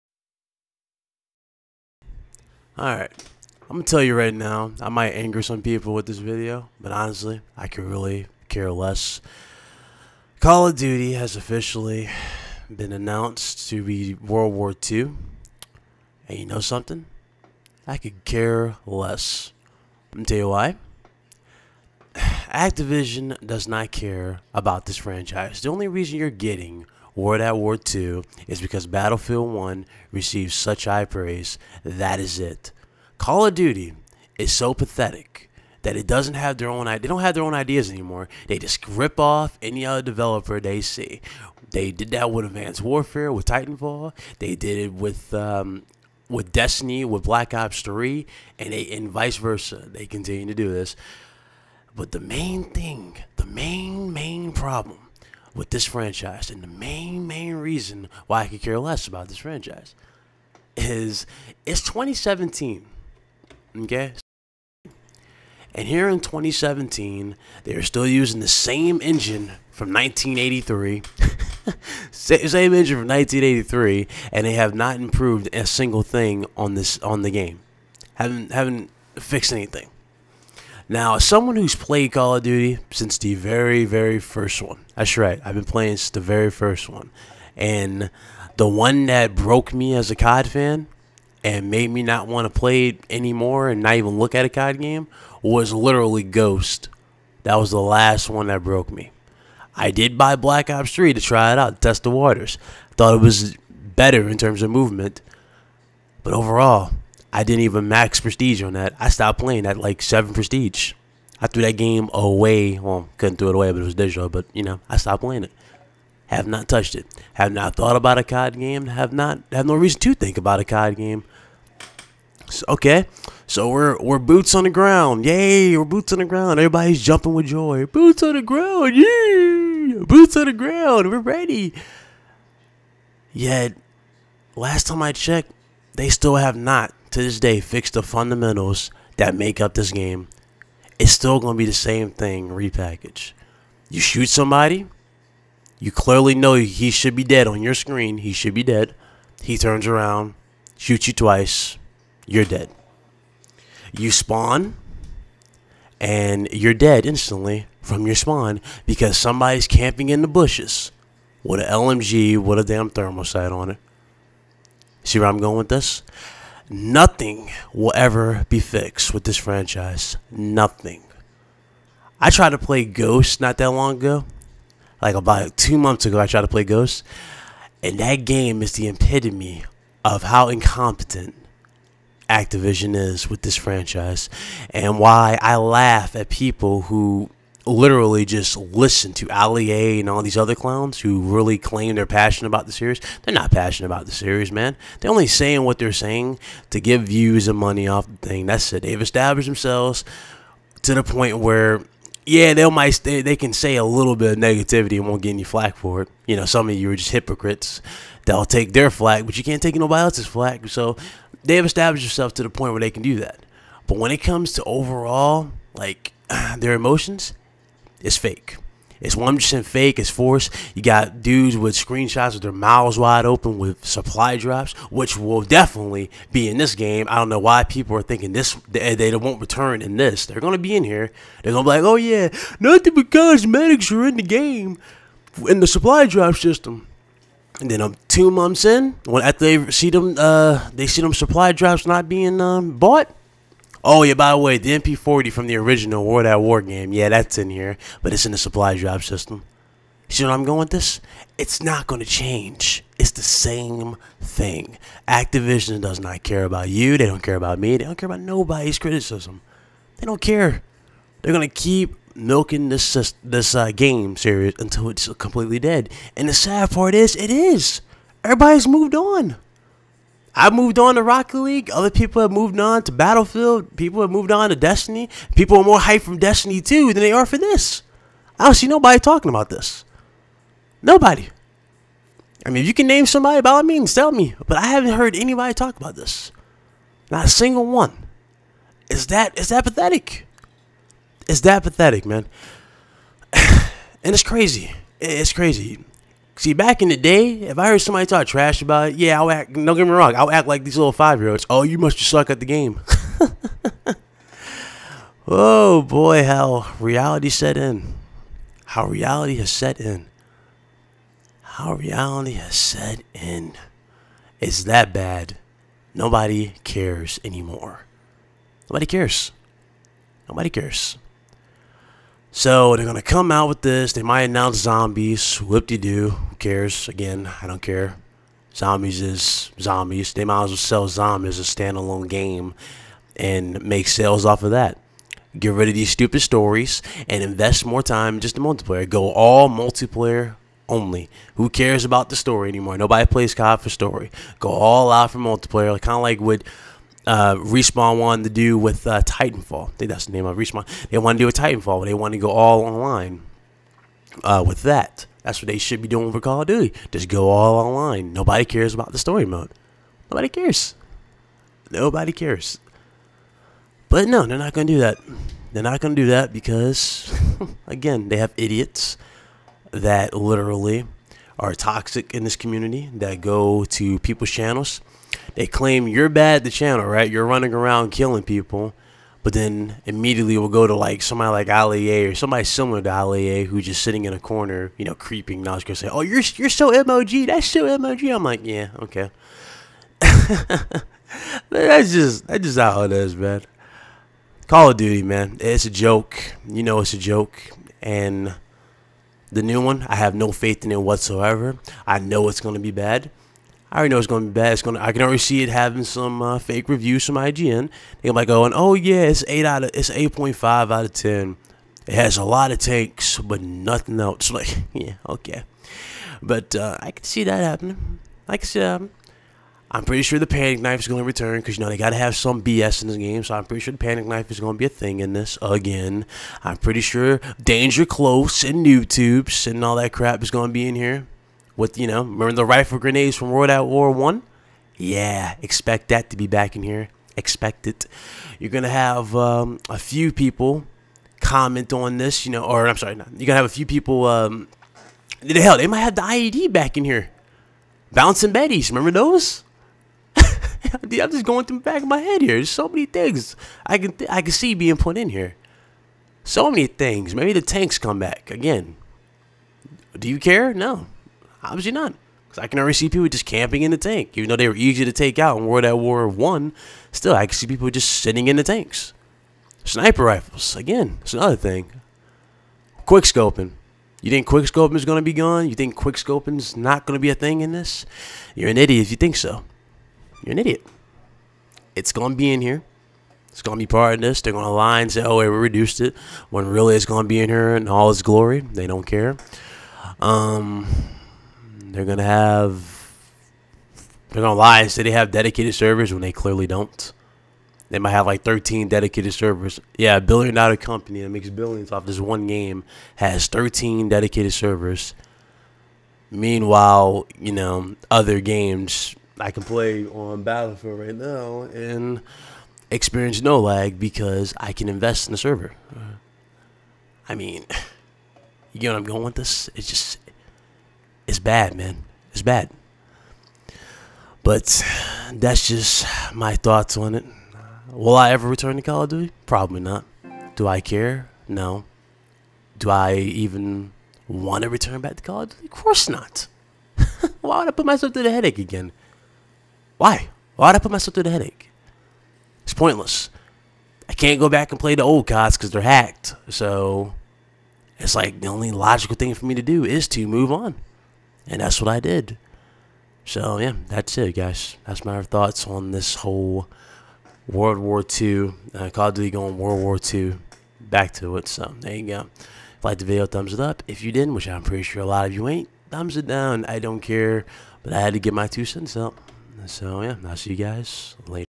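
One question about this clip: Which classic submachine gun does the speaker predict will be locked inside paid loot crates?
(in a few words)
MP40.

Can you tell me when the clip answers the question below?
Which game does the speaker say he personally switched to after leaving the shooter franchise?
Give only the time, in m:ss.
4:31.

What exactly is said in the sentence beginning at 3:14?
They're only saying what they're saying to give views and money off the thing.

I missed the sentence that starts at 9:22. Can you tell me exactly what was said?
If you liked the video, thumbs it up.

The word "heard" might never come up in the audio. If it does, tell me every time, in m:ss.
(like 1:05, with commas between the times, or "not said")
4:44, 4:57.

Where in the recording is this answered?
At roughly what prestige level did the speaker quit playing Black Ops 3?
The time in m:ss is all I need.
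1:50.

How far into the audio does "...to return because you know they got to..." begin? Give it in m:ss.
7:00.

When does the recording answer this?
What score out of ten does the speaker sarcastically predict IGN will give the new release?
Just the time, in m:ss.
6:49.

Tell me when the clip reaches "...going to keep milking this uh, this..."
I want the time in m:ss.
4:21.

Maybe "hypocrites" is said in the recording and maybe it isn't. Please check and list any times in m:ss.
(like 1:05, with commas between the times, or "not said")
3:27.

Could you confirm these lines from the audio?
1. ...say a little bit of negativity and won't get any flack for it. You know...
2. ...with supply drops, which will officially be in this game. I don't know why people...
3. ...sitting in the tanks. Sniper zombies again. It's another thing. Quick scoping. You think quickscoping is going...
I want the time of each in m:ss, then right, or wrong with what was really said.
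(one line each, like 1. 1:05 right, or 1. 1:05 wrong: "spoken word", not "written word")
1. 3:23 right
2. 3:43 wrong: "definitely", not "officially"
3. 7:48 wrong: "rifles", not "zombies".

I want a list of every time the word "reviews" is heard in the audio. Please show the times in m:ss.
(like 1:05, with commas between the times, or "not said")
6:46.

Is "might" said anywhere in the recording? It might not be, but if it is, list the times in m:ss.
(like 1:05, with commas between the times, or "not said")
0:04, 3:22, 5:24, 5:30, 6:48, 7:25, 8:17.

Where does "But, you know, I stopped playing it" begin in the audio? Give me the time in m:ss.
1:54.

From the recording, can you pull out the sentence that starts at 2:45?
See where I'm going with this?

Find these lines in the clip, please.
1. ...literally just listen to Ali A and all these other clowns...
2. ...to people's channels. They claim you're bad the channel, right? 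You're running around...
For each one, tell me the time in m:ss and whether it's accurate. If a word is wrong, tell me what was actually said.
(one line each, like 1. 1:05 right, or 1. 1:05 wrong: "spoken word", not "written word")
1. 3:07 right
2. 6:13 right.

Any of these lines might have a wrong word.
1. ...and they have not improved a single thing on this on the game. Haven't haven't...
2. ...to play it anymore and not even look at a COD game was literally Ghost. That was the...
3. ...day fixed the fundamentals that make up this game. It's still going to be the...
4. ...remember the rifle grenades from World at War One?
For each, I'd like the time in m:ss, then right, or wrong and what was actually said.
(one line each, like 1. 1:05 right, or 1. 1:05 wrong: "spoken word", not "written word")
1. 1:14 right
2. 1:32 right
3. 2:17 right
4. 7:12 right.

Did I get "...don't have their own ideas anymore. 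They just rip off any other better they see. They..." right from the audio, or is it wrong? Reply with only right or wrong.
wrong.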